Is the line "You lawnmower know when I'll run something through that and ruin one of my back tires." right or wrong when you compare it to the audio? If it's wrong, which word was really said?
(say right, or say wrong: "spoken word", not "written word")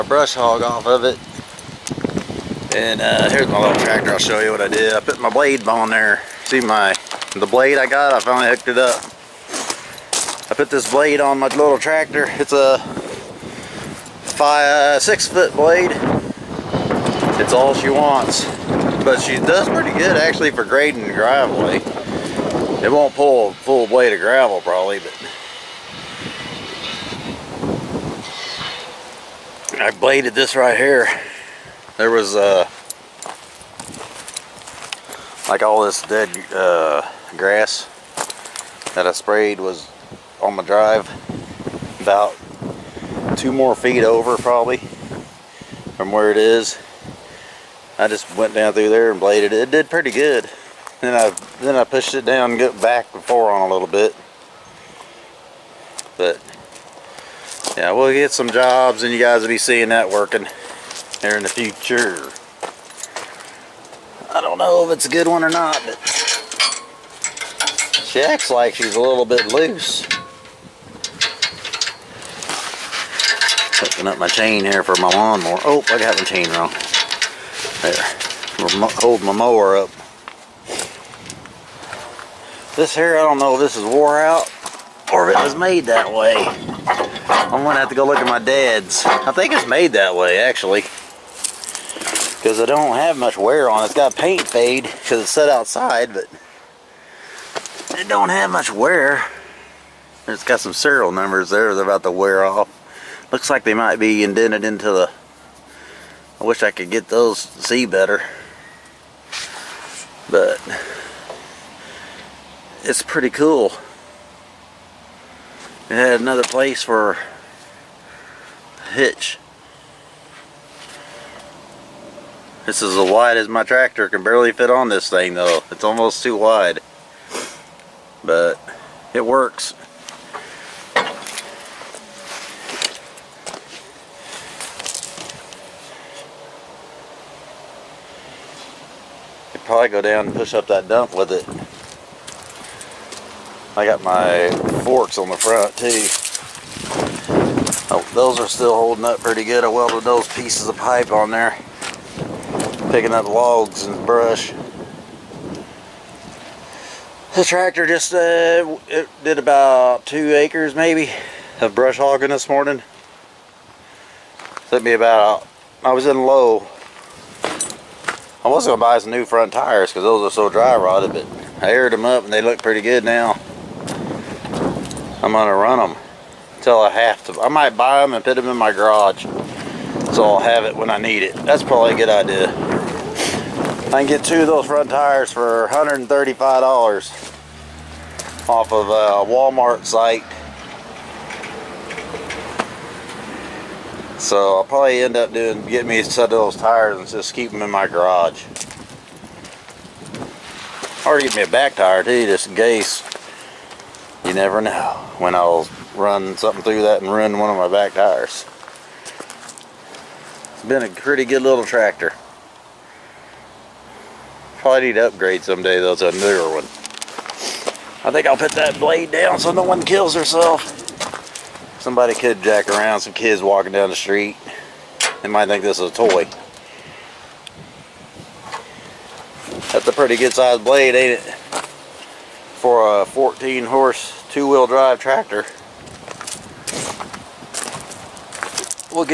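wrong: "never", not "lawnmower".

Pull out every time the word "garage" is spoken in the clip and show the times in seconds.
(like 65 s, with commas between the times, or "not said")
178 s, 197 s.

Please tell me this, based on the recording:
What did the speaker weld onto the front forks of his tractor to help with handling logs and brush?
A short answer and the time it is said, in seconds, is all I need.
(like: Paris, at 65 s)
pieces of pipe, at 150 s.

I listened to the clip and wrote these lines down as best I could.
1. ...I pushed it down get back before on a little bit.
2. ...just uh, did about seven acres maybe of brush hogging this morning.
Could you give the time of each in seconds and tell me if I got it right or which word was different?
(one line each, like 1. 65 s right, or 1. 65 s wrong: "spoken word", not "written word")
1. 51 s right
2. 157 s wrong: "two", not "seven".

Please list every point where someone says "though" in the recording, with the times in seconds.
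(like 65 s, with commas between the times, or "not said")
125 s, 215 s.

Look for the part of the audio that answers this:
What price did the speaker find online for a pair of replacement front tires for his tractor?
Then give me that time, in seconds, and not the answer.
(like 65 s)
185 s.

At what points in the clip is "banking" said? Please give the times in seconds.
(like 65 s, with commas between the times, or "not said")
not said.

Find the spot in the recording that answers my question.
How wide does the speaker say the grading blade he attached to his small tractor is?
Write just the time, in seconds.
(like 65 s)
12 s.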